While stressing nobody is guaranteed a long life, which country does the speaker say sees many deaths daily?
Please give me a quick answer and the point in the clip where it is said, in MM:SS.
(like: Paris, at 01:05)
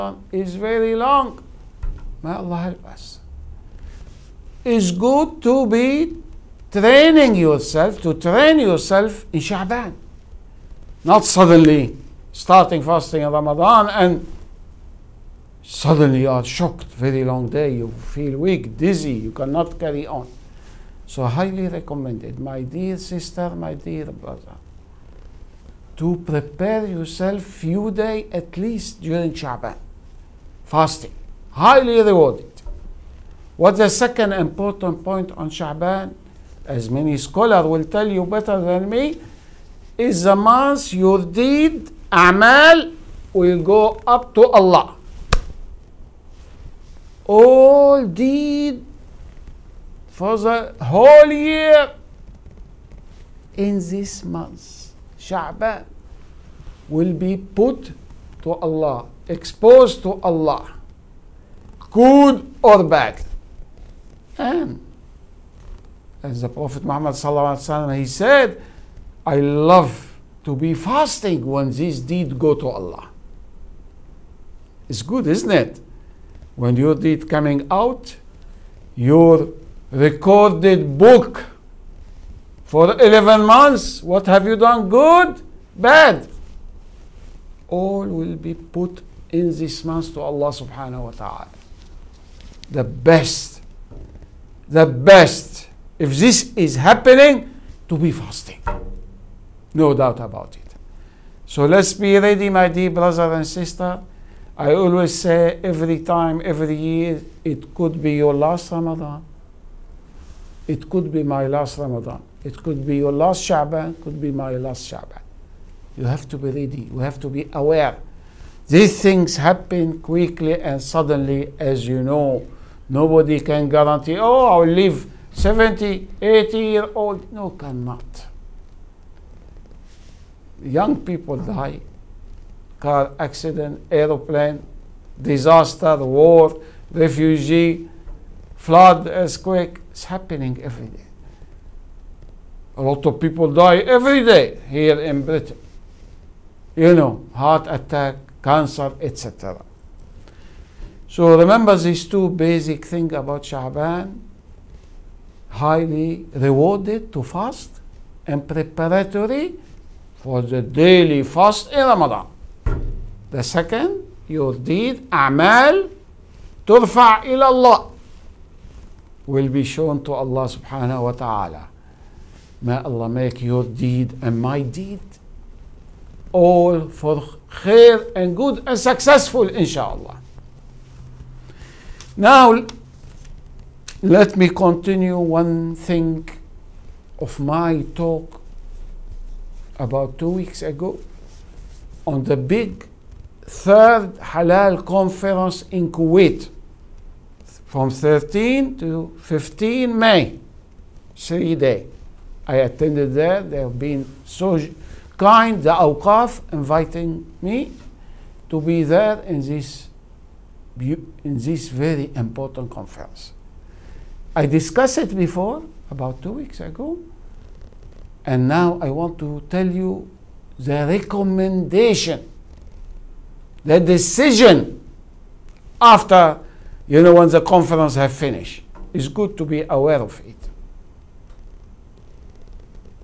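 Britain, at 02:25.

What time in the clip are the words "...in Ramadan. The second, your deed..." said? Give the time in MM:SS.
02:41.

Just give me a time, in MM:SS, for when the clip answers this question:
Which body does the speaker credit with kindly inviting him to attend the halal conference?
03:25.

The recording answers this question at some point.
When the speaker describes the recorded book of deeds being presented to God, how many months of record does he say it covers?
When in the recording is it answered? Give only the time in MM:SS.
01:22.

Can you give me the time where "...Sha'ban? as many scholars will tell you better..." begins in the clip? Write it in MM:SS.
00:35.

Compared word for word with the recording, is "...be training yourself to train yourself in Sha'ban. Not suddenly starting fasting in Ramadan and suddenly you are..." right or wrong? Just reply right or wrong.
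right.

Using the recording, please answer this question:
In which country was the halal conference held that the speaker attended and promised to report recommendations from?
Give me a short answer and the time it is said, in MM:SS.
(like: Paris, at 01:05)
Kuwait, at 03:15.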